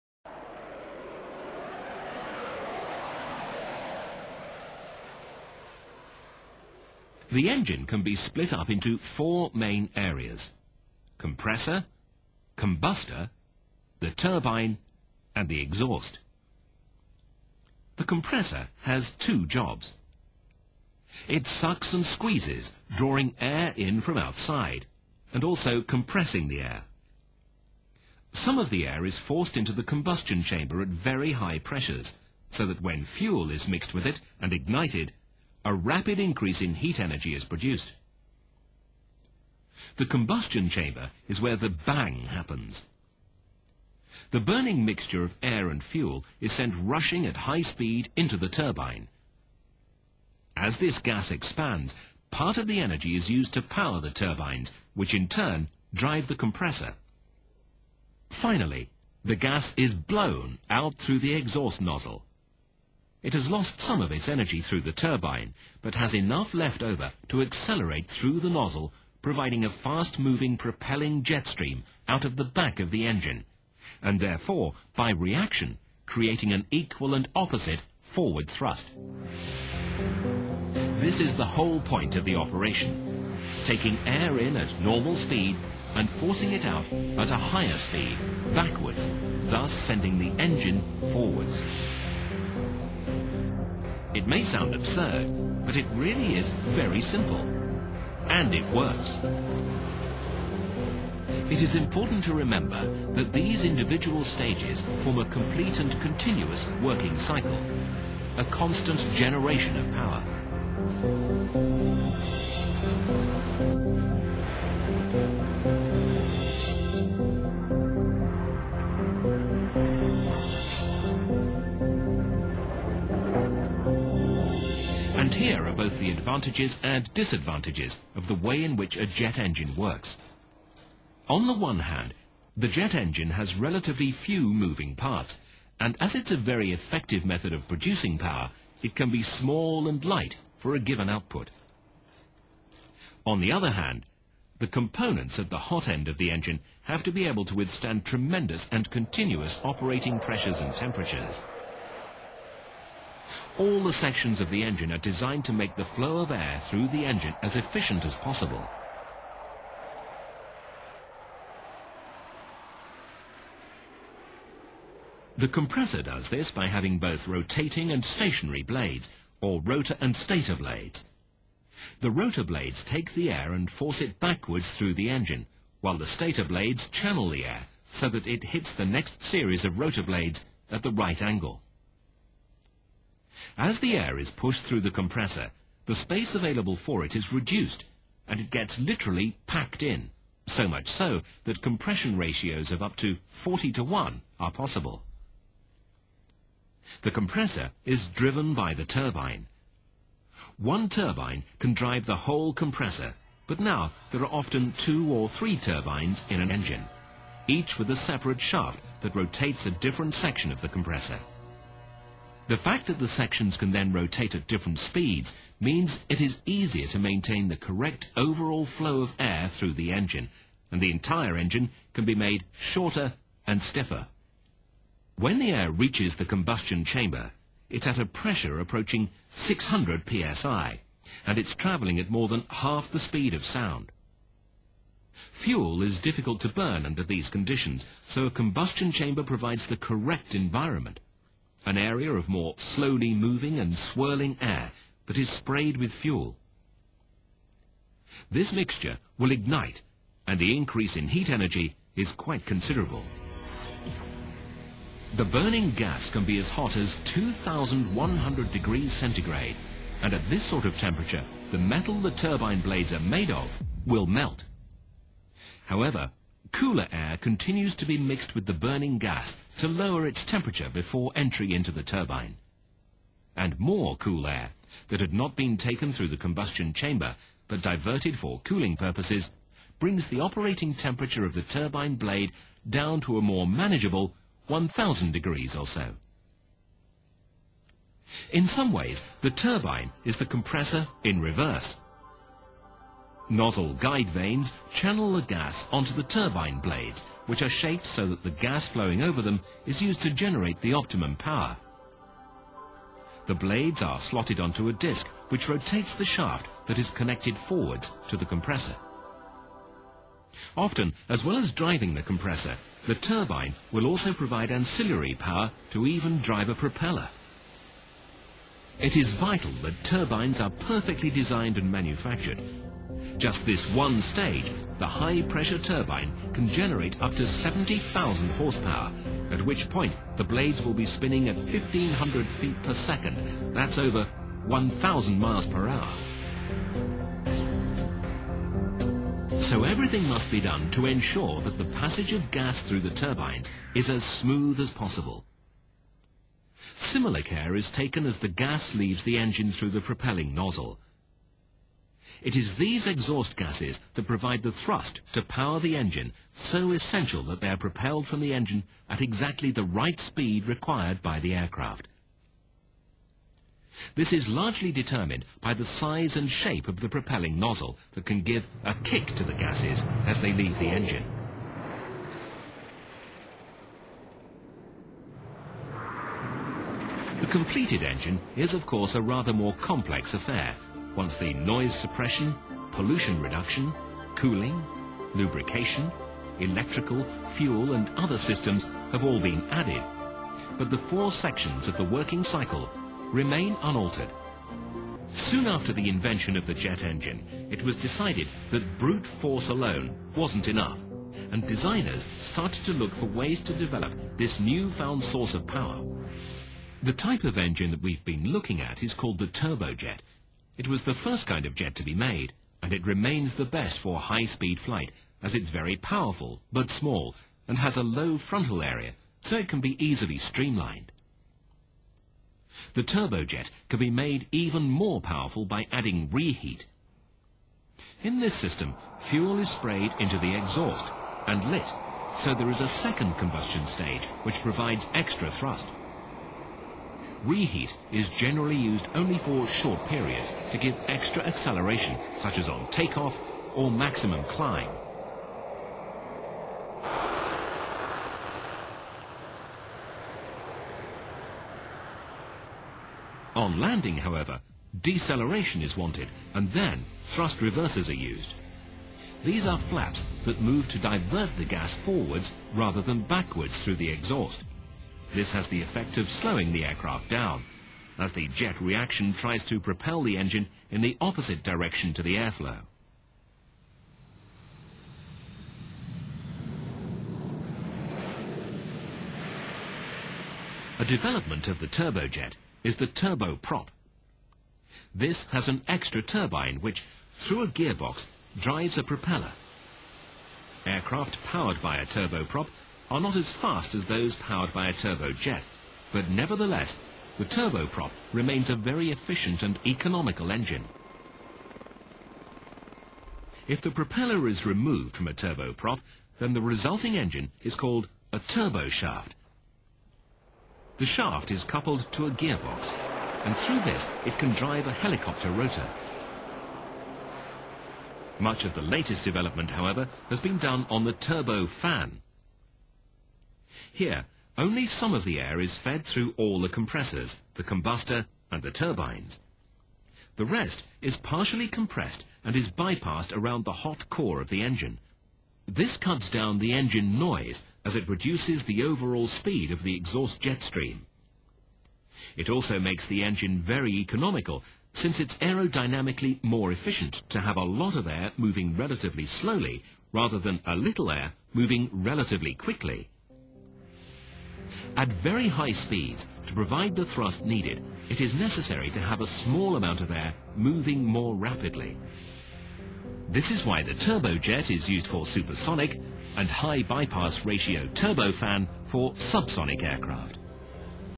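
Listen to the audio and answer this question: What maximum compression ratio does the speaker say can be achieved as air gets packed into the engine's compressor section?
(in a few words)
40 to 1.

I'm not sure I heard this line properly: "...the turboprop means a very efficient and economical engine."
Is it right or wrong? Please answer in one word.
wrong.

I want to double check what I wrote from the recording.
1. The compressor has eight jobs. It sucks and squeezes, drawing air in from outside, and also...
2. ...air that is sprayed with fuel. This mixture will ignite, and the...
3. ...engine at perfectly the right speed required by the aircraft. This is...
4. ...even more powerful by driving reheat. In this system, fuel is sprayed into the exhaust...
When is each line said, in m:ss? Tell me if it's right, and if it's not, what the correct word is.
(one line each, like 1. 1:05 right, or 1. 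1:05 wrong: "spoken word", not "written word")
1. 0:17 wrong: "two", not "eight"
2. 4:04 right
3. 5:58 wrong: "exactly", not "perfectly"
4. 7:04 wrong: "adding", not "driving".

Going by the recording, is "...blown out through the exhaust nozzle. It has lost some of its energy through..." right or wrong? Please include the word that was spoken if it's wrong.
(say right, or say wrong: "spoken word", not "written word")
right.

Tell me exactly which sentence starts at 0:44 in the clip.
The burning mixture of air and fuel is sent rushing at high speed into the turbine.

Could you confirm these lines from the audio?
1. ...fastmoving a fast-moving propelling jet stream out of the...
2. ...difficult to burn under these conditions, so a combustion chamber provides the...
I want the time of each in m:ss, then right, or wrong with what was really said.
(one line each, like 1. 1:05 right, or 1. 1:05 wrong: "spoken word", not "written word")
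1. 1:09 wrong: "providing", not "fastmoving"
2. 3:55 right.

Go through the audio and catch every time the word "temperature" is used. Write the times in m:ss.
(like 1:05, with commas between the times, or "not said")
2:30, 4:20, 4:30, 4:40.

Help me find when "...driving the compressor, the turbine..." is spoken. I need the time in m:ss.
5:11.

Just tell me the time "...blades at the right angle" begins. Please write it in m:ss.
3:00.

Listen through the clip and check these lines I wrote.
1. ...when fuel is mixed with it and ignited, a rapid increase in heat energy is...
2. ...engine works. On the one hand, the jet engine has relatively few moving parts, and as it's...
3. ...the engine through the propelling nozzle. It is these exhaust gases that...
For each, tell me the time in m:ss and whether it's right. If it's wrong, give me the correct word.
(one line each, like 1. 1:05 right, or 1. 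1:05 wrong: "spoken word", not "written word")
1. 0:32 right
2. 2:09 right
3. 5:49 right.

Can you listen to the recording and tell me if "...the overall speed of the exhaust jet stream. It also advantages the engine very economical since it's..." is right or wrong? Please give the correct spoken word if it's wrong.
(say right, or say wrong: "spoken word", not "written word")
wrong: "makes", not "advantages".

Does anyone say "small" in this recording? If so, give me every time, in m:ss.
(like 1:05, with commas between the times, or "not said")
2:19, 6:56, 9:19.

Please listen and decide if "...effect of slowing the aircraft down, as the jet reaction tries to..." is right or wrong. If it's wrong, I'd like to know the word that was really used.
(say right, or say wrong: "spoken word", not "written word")
right.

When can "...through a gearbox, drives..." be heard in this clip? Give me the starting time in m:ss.
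8:07.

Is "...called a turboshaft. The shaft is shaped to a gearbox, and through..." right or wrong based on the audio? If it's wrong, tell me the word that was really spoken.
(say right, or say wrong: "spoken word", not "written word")
wrong: "coupled", not "shaped".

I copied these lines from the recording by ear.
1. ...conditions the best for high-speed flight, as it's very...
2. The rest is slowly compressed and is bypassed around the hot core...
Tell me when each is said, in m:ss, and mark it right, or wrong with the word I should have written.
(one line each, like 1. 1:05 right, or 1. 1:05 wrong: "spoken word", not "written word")
1. 6:52 wrong: "remains", not "conditions"
2. 8:50 wrong: "partially", not "slowly".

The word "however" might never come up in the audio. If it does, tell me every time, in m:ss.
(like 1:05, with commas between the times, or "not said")
4:25, 7:33, 8:39.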